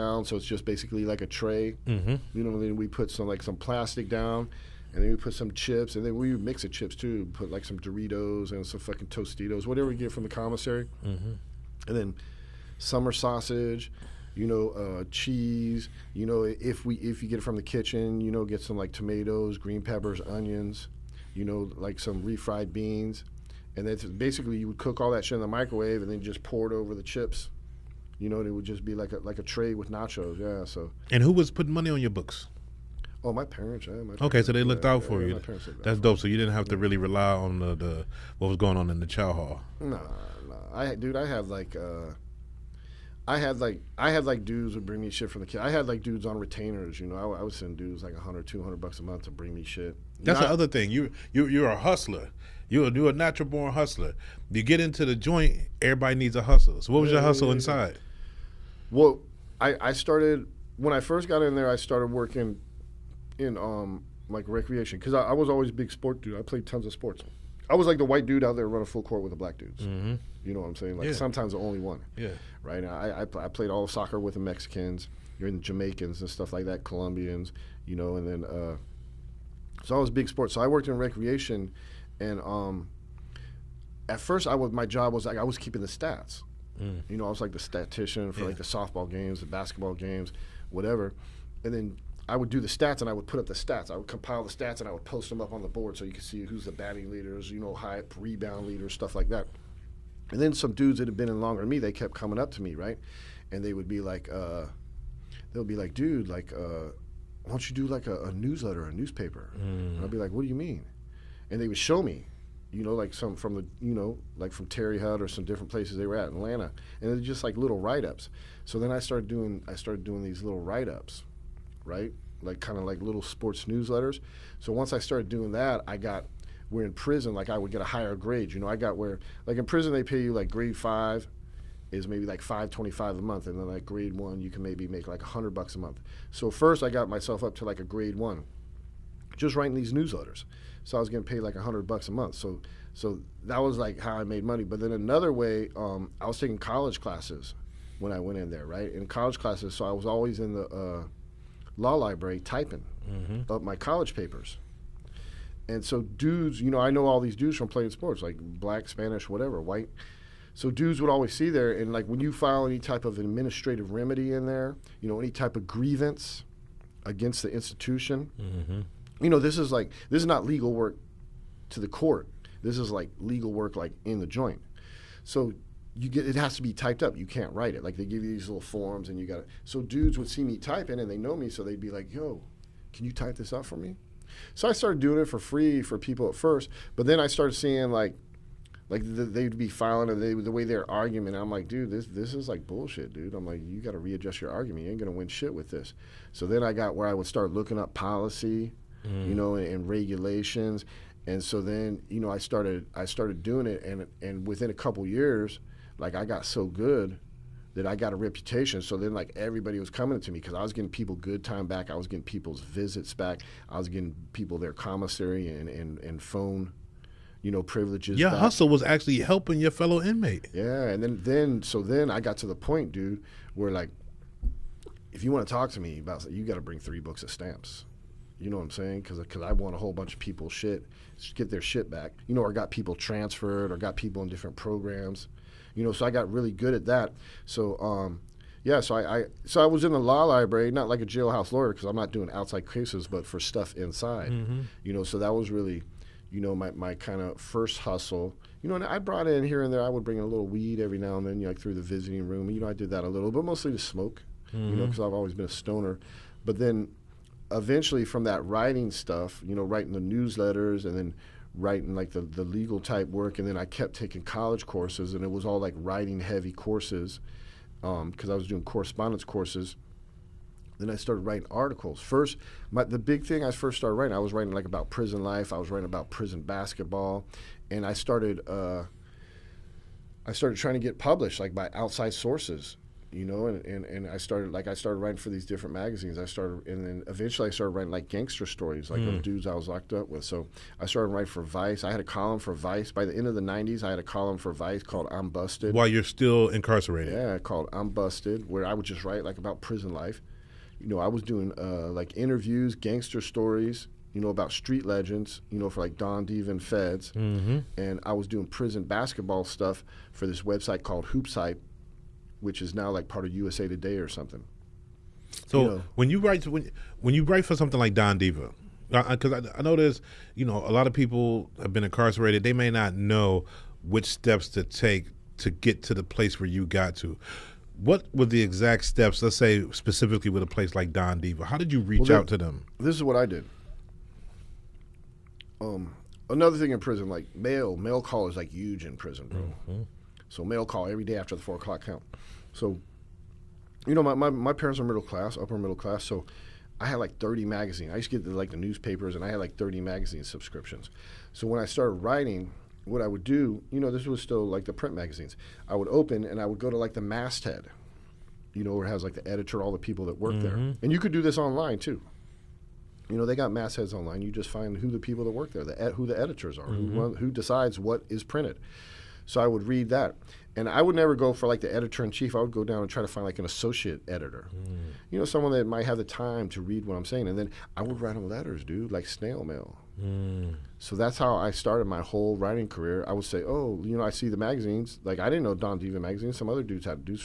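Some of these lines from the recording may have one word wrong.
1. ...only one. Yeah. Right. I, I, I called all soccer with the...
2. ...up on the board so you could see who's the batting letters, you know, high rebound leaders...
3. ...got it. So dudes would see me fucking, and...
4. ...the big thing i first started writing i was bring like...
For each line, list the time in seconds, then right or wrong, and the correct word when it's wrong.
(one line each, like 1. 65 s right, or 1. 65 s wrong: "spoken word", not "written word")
1. 71 s wrong: "played", not "called"
2. 95 s wrong: "leaders", not "letters"
3. 179 s wrong: "typing", not "fucking"
4. 272 s wrong: "writing", not "bring".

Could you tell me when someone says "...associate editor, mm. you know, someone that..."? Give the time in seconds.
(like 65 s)
373 s.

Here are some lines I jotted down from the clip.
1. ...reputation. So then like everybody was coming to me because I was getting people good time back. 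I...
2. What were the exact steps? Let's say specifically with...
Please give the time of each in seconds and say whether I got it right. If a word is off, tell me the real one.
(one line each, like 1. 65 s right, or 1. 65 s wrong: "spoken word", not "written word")
1. 208 s right
2. 327 s right.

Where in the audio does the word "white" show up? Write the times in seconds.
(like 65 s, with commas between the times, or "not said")
68 s, 159 s.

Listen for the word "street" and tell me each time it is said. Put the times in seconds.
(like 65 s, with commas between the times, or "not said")
304 s.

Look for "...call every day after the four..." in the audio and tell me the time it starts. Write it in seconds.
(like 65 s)
340 s.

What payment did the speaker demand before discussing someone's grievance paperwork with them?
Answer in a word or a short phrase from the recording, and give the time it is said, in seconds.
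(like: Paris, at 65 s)
three books of stamps, at 226 s.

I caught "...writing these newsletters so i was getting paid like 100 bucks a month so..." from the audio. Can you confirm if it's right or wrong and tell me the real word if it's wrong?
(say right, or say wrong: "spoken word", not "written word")
right.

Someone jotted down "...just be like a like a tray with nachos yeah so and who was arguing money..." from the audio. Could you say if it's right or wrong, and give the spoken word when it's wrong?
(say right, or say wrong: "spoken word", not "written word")
wrong: "putting", not "arguing".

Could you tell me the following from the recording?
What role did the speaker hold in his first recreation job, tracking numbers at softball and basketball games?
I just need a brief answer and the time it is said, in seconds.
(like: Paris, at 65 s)
statistician, at 87 s.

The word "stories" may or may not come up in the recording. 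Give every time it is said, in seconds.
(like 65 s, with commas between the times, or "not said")
288 s, 303 s.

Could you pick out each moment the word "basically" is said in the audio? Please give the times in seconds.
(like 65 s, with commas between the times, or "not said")
0 s, 24 s.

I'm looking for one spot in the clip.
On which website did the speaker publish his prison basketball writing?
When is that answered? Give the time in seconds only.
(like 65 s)
311 s.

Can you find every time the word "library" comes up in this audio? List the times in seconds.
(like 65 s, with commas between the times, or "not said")
151 s, 240 s.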